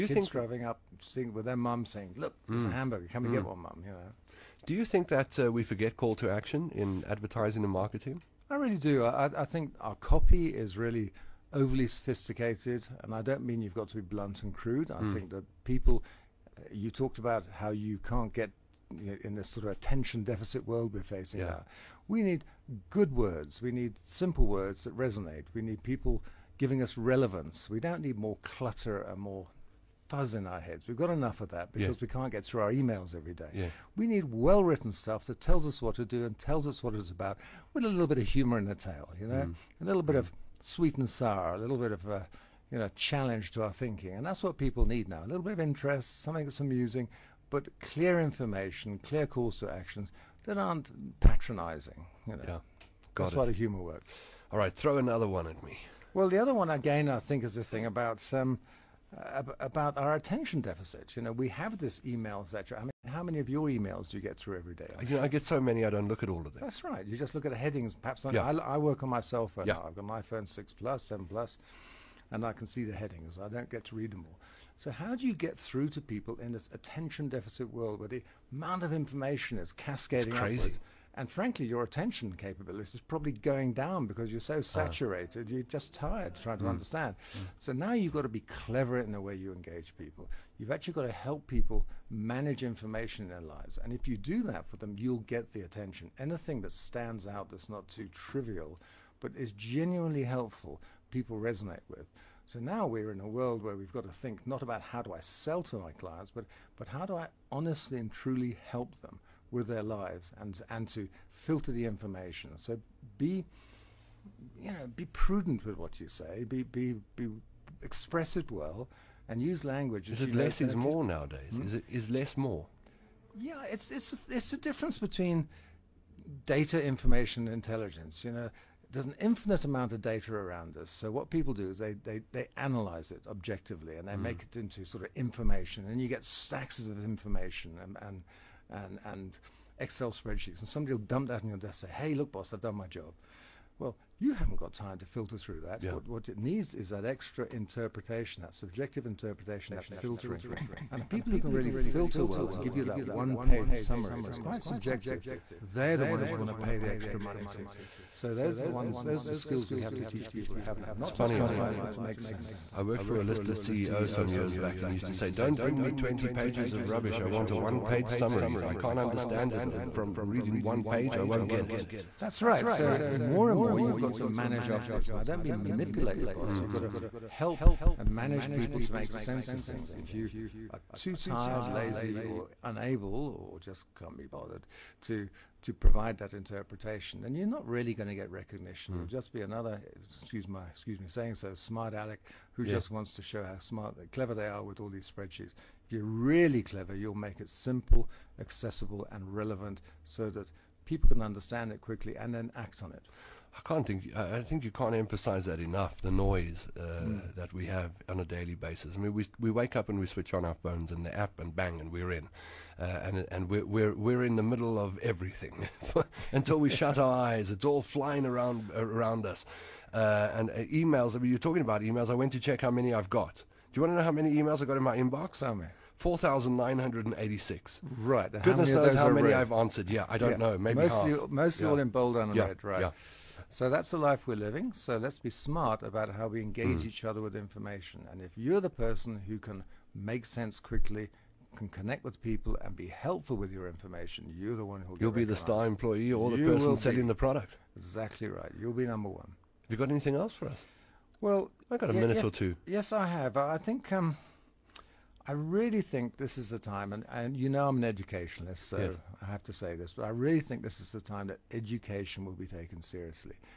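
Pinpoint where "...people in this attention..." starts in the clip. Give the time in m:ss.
1:16.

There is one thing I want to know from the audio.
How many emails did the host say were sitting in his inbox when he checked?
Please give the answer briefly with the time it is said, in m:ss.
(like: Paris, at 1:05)
4,986, at 3:45.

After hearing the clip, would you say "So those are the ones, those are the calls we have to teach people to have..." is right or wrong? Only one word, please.
wrong.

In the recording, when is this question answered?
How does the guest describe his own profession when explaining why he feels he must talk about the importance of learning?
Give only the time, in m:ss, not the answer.
4:17.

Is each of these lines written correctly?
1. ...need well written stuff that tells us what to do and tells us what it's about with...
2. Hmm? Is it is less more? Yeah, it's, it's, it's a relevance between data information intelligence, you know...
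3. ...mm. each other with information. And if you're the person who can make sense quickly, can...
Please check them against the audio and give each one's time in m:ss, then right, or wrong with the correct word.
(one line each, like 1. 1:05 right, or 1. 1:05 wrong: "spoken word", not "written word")
1. 0:34 right
2. 2:01 wrong: "difference", not "relevance"
3. 3:56 right.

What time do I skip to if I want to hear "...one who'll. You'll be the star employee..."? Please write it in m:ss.
4:04.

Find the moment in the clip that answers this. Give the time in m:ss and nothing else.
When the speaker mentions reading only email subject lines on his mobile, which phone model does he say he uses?
1:11.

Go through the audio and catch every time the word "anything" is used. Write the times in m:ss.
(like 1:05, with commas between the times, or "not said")
1:36, 4:09.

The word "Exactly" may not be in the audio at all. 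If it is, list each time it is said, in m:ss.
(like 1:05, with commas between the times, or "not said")
4:07.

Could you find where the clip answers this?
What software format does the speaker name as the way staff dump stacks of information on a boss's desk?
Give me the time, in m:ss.
2:19.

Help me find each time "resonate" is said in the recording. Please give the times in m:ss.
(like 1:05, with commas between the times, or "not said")
0:24, 1:41.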